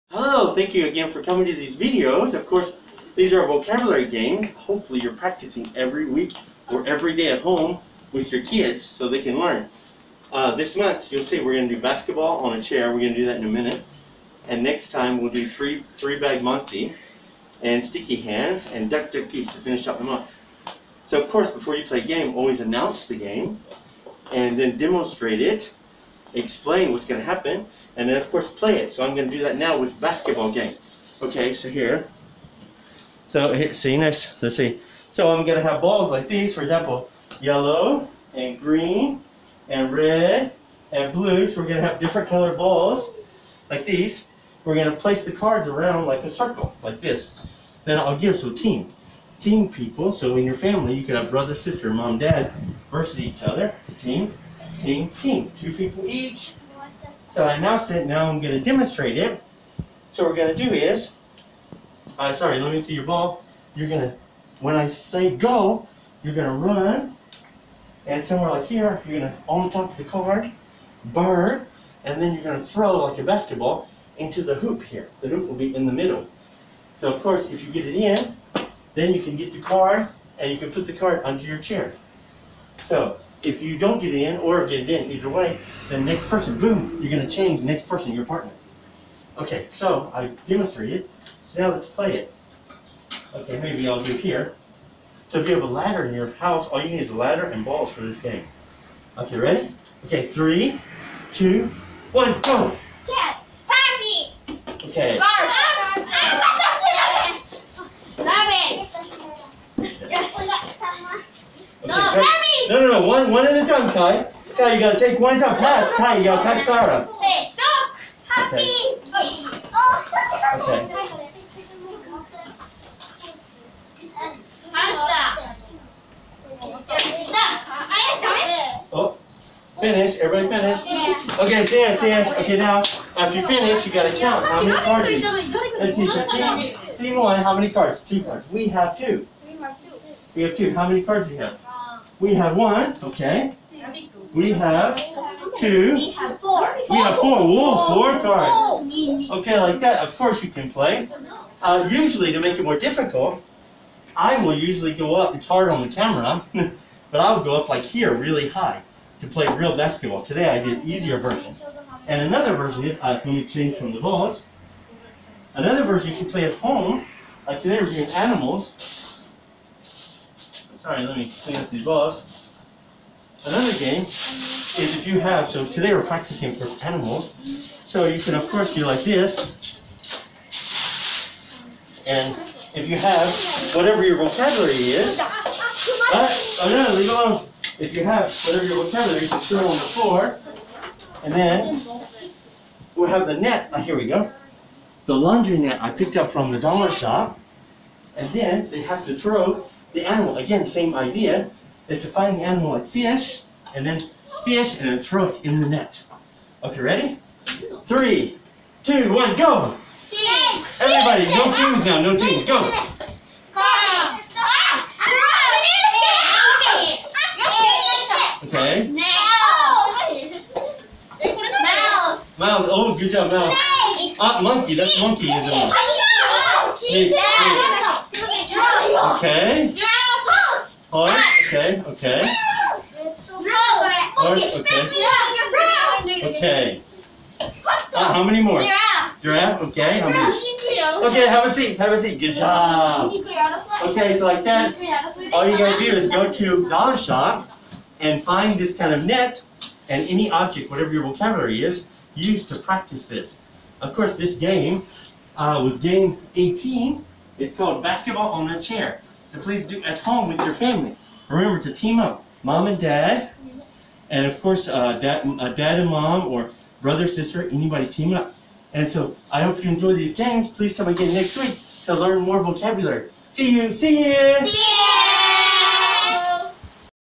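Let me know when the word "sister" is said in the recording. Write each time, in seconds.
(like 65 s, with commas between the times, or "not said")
51 s, 267 s.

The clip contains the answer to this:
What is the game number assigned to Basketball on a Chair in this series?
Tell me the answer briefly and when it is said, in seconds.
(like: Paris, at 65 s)
18, at 255 s.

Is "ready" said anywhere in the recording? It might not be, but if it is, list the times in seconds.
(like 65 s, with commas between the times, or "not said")
99 s, 206 s.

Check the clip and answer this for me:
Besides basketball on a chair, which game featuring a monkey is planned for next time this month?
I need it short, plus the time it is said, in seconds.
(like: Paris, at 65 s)
Three bag monkey, at 15 s.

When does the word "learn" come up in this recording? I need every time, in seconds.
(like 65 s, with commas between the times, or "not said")
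9 s, 271 s.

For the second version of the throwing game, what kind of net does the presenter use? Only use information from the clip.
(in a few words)
Laundry net.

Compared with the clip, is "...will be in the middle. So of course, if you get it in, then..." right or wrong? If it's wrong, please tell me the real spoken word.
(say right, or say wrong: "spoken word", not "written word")
right.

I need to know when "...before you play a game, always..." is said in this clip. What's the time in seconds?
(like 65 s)
21 s.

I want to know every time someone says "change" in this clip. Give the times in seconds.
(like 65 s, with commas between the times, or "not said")
87 s, 163 s.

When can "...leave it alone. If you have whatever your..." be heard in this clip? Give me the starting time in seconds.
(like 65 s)
186 s.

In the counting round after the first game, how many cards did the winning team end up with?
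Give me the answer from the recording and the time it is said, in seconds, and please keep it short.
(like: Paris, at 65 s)
4, at 147 s.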